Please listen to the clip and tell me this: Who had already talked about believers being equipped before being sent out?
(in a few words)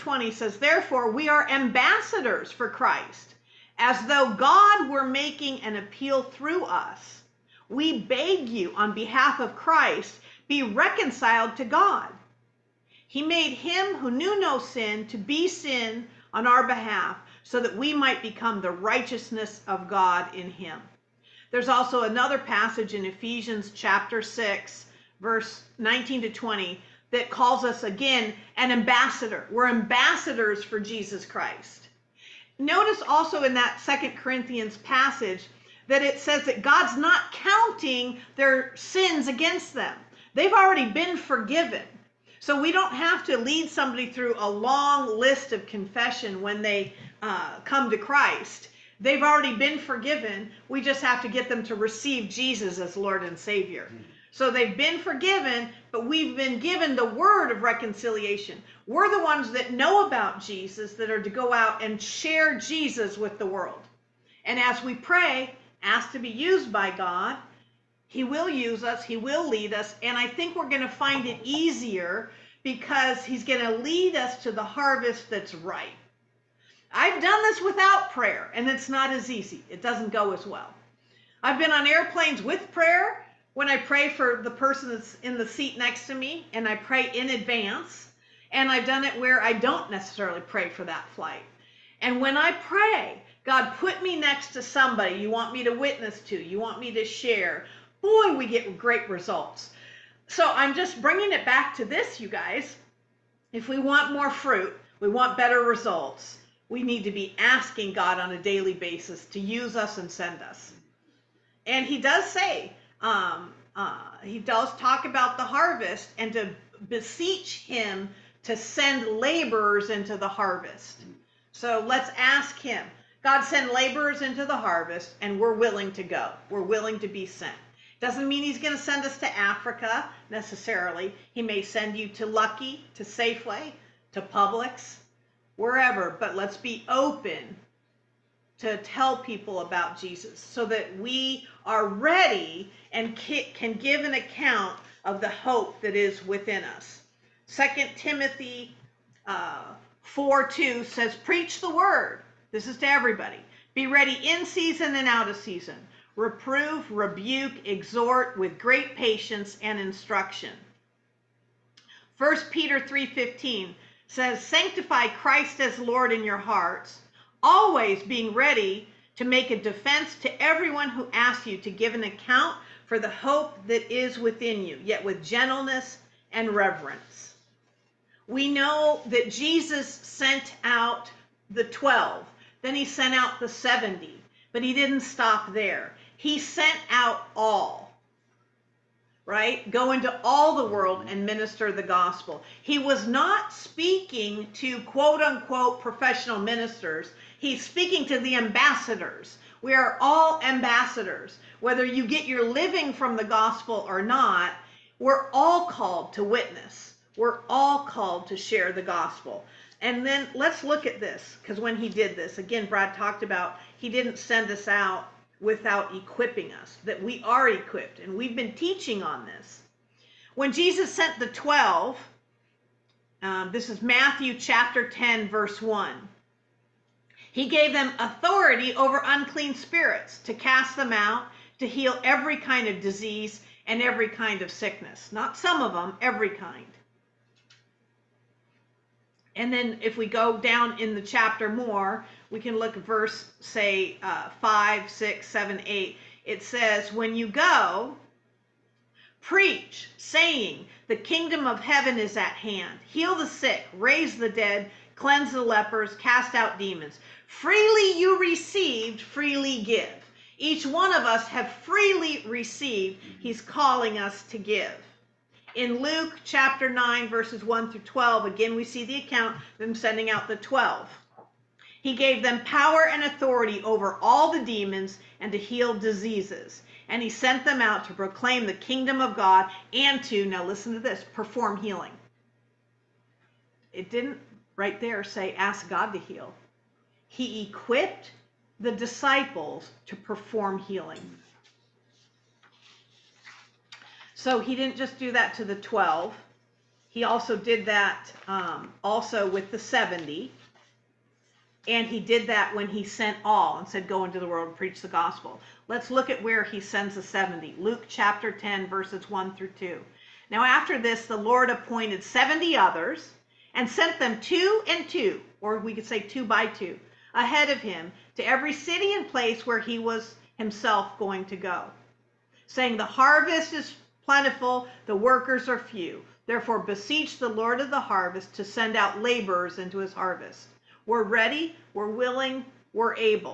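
Brad.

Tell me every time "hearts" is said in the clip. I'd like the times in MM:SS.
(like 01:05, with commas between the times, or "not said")
02:46.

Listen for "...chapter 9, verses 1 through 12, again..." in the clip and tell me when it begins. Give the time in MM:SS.
04:26.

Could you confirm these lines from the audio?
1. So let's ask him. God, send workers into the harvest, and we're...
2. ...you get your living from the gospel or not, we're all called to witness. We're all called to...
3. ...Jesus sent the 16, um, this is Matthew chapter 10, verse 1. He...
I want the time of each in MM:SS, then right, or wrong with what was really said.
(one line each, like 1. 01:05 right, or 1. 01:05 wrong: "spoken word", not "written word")
1. 02:01 wrong: "laborers", not "workers"
2. 03:21 right
3. 03:40 wrong: "12", not "16".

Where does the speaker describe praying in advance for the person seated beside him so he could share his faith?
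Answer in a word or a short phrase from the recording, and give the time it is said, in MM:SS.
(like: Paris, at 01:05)
On airplanes, at 01:21.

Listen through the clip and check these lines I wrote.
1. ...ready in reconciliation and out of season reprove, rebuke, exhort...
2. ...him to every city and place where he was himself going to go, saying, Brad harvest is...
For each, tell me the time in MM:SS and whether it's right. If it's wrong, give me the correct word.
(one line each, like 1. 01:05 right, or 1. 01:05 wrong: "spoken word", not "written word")
1. 02:33 wrong: "season", not "reconciliation"
2. 05:17 wrong: "The", not "Brad".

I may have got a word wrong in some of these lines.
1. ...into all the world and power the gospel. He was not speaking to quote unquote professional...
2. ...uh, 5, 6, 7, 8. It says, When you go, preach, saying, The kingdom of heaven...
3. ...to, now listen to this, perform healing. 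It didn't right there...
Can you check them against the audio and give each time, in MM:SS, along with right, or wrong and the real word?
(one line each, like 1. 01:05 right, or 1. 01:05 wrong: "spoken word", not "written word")
1. 03:09 wrong: "minister", not "power"
2. 04:04 right
3. 04:40 right.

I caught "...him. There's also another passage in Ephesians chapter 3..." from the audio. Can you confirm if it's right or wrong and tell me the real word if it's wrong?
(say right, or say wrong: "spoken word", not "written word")
wrong: "6", not "3".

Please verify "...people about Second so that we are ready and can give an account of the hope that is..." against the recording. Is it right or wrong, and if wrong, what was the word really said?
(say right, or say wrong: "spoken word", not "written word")
wrong: "Jesus", not "Second".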